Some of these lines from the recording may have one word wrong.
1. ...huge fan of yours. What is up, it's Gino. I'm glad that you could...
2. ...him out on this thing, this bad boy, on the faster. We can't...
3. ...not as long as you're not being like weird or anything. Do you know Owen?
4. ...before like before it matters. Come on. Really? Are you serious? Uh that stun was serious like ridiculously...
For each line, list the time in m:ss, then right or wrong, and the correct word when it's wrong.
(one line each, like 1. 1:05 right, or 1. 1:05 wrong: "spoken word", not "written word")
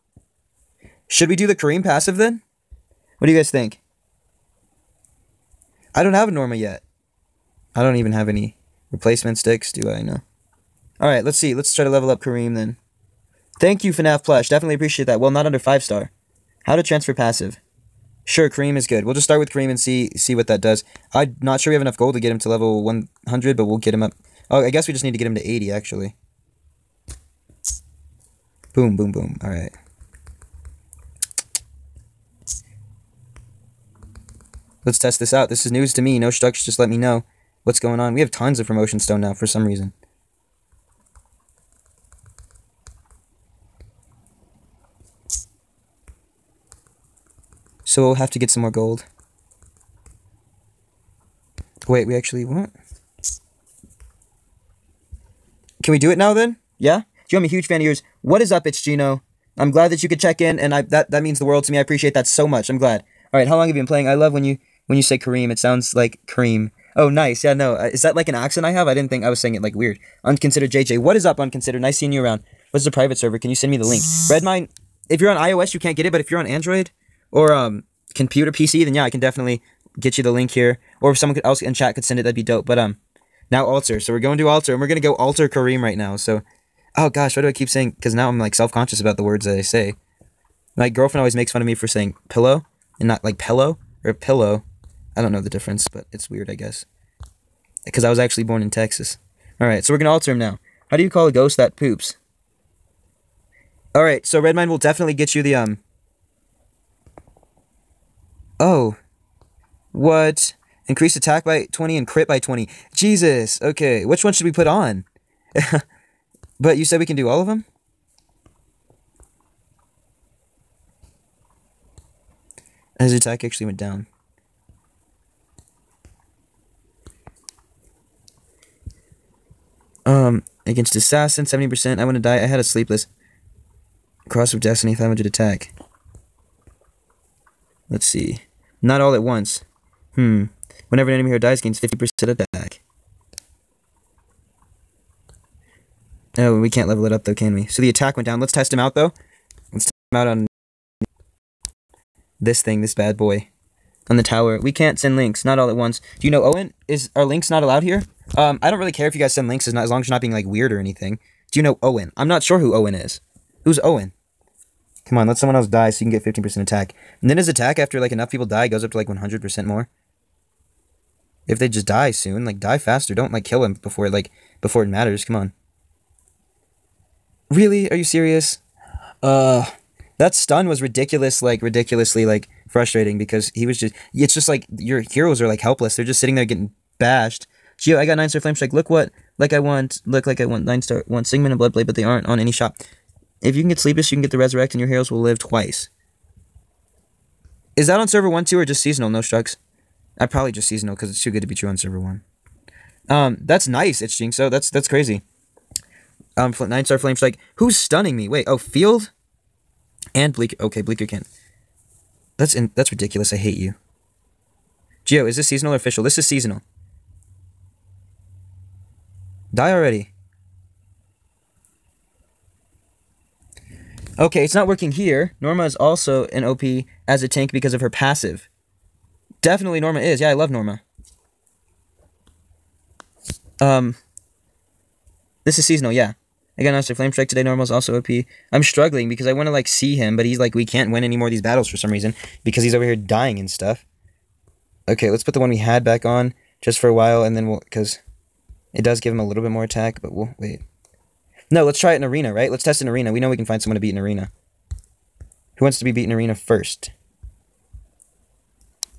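1. 0:57 right
2. 2:30 wrong: "tower", not "faster"
3. 2:39 right
4. 2:53 wrong: "ridiculous", not "serious".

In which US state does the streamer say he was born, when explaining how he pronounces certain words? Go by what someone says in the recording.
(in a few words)
Texas.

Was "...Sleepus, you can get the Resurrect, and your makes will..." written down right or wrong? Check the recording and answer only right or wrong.
wrong.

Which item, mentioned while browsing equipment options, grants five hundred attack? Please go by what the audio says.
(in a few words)
Cross of destiny.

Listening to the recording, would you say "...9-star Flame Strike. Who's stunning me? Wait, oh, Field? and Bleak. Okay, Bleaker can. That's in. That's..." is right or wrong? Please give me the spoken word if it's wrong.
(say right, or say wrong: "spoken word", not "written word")
right.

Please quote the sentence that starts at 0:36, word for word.
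No structs, just let me know what's going on.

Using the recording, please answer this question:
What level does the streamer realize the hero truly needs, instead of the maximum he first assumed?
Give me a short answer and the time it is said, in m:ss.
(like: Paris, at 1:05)
80, at 0:25.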